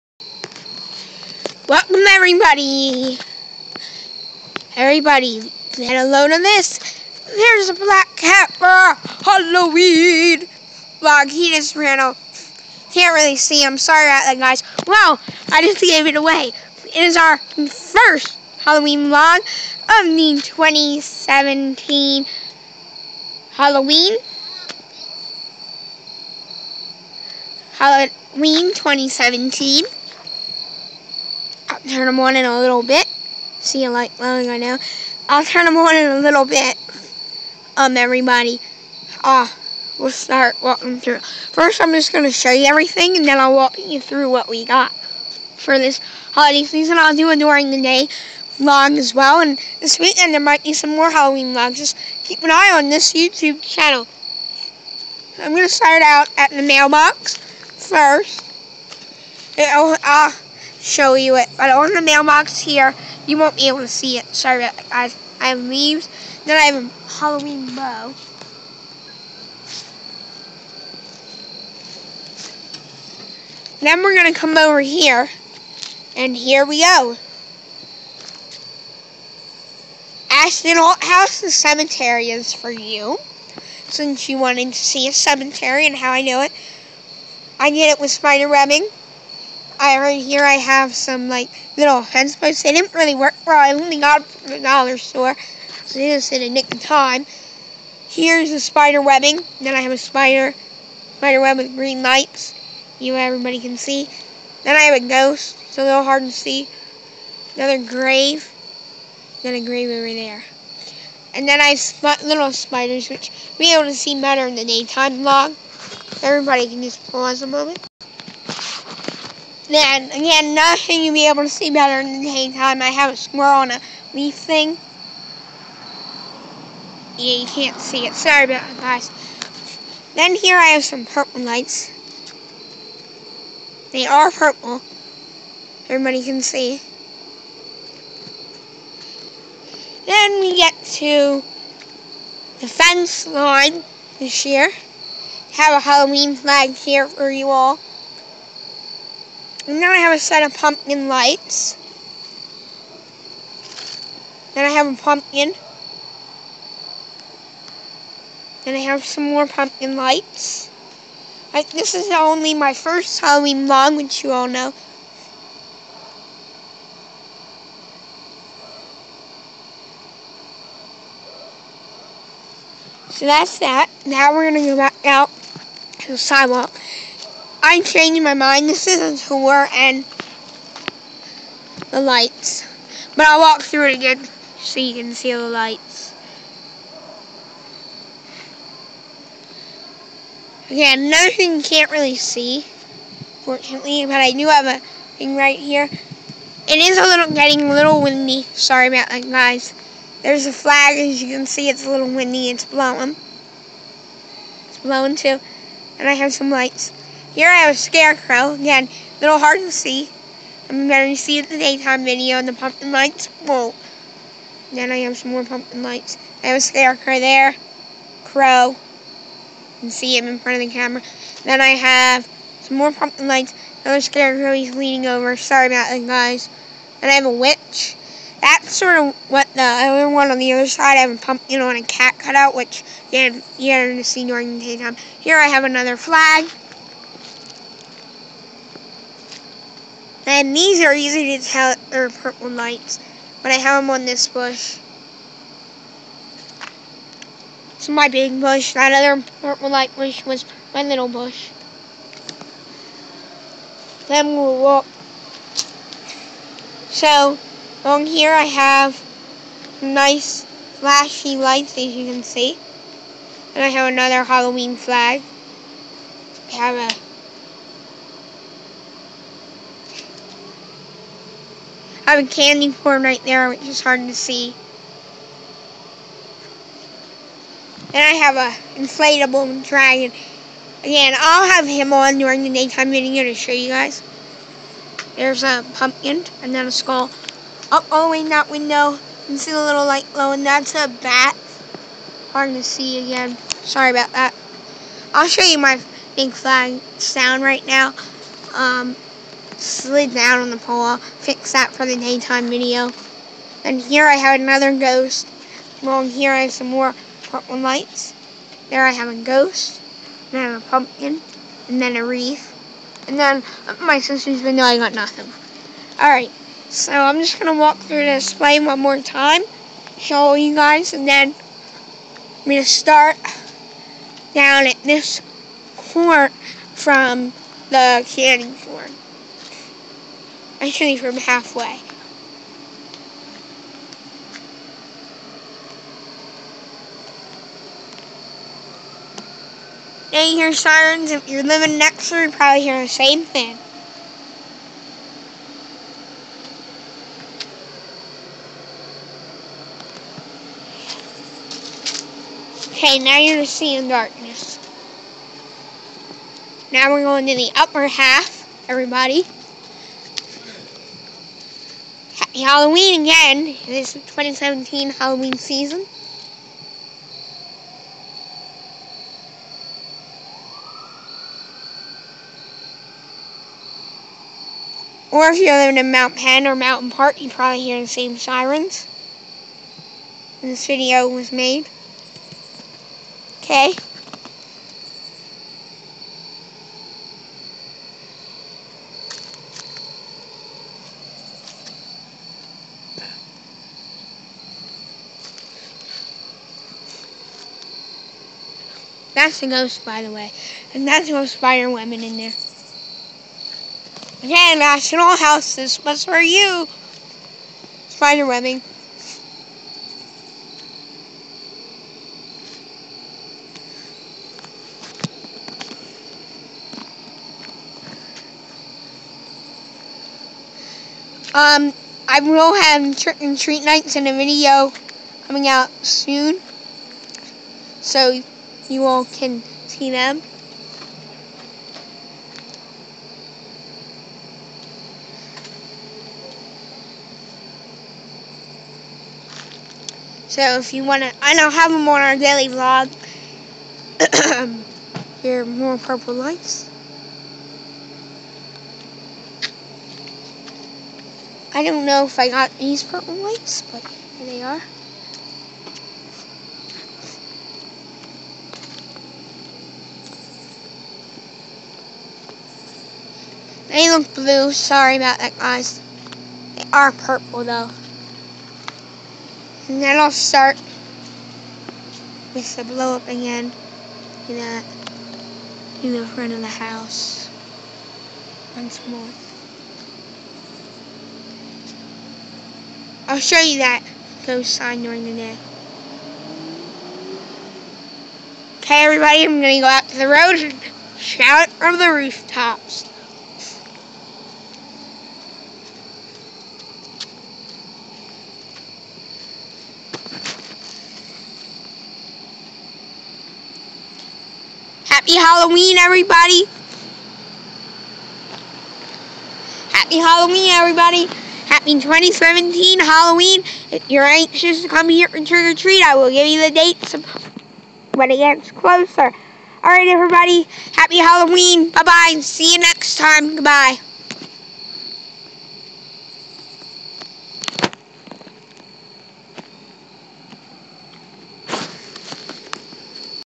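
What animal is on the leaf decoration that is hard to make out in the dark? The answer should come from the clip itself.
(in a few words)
A squirrel.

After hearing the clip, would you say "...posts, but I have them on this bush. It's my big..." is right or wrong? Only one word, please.
wrong.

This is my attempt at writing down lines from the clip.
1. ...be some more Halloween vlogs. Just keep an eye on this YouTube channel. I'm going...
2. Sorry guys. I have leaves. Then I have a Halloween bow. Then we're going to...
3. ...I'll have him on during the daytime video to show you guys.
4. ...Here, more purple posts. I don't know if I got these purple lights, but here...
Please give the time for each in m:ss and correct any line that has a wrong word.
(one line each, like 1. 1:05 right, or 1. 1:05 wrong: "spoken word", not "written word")
1. 0:50 right
2. 1:04 right
3. 4:41 right
4. 7:25 wrong: "lights", not "posts".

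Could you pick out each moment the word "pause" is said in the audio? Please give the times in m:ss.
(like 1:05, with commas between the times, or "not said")
1:57.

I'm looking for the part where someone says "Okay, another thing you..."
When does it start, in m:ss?
3:10.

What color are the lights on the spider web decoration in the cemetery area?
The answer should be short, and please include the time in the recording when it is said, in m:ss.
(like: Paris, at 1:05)
Green, at 1:41.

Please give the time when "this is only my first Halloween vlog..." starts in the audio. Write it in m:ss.
2:41.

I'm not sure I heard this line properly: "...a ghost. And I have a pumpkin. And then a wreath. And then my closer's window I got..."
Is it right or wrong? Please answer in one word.
wrong.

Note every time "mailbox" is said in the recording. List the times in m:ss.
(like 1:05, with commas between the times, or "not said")
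0:56, 1:02.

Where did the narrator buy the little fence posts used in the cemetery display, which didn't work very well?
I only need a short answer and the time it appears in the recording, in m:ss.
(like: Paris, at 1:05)
The dollar store, at 1:34.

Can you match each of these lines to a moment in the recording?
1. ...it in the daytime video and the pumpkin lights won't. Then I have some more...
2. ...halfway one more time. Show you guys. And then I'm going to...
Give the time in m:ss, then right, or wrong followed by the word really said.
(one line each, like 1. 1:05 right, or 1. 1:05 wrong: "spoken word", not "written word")
1. 3:31 right
2. 5:18 wrong: "display", not "halfway".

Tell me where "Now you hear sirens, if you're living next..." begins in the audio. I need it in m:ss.
5:40.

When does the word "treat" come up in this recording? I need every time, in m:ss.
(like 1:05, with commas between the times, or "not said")
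7:03, 8:35.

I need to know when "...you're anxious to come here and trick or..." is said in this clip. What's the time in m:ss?
8:33.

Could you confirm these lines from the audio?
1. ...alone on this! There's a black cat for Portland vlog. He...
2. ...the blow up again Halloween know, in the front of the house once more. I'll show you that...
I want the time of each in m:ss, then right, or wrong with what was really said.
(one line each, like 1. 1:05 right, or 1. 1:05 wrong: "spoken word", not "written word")
1. 0:06 wrong: "Halloween", not "Portland"
2. 7:52 wrong: "You", not "Halloween".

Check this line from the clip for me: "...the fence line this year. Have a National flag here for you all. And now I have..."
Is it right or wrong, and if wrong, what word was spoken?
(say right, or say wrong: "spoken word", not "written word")
wrong: "Halloween", not "National".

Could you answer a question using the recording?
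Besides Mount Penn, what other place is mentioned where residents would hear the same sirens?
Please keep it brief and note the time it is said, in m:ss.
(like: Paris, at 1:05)
Mountain Park, at 6:16.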